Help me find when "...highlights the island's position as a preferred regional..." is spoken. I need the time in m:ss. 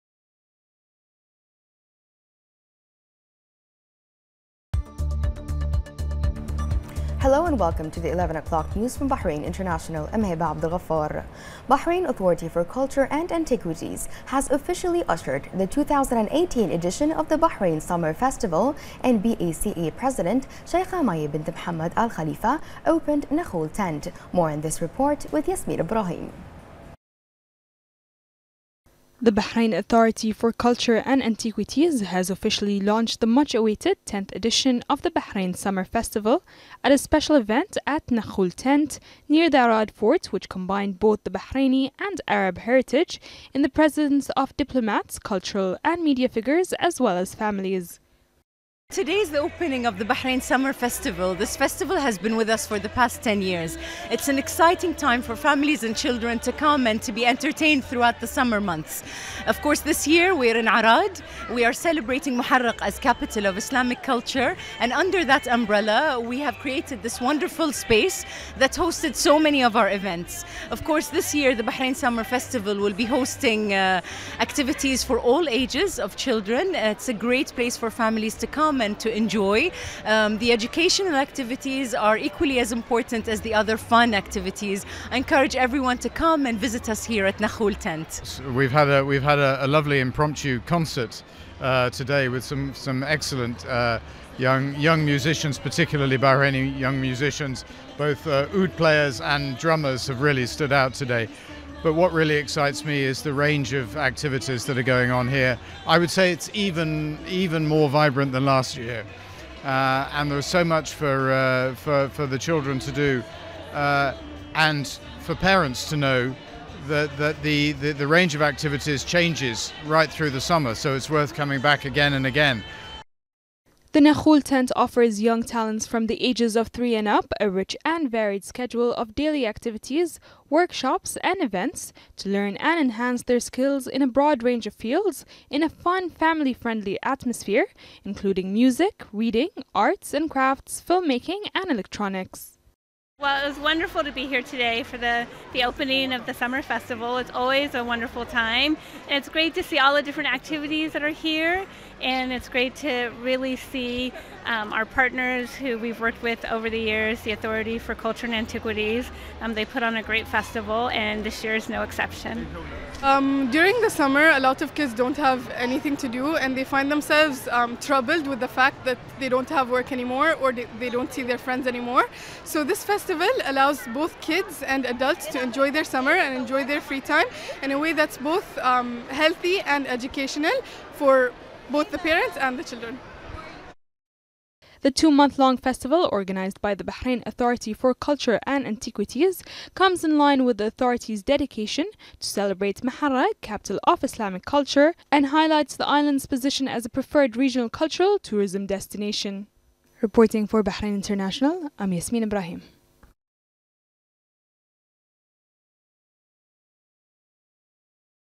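3:15.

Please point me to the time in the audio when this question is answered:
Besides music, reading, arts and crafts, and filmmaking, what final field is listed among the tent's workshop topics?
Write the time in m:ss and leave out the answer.
2:21.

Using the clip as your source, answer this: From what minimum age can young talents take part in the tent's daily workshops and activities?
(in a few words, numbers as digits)
3.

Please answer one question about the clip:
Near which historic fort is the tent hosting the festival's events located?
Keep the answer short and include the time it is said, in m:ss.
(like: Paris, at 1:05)
Arad Fort, at 0:39.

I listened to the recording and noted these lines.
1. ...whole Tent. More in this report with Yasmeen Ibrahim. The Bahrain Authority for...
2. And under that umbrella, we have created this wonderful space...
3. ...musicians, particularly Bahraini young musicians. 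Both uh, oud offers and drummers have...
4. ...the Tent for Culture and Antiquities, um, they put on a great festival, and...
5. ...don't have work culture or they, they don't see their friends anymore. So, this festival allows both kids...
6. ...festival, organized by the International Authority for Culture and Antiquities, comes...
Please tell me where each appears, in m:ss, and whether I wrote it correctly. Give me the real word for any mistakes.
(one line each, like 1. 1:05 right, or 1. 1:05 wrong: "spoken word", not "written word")
1. 0:23 right
2. 1:04 right
3. 1:35 wrong: "players", not "offers"
4. 2:37 wrong: "Authority", not "Tent"
5. 2:49 wrong: "anymore", not "culture"
6. 3:05 wrong: "Bahrain", not "International".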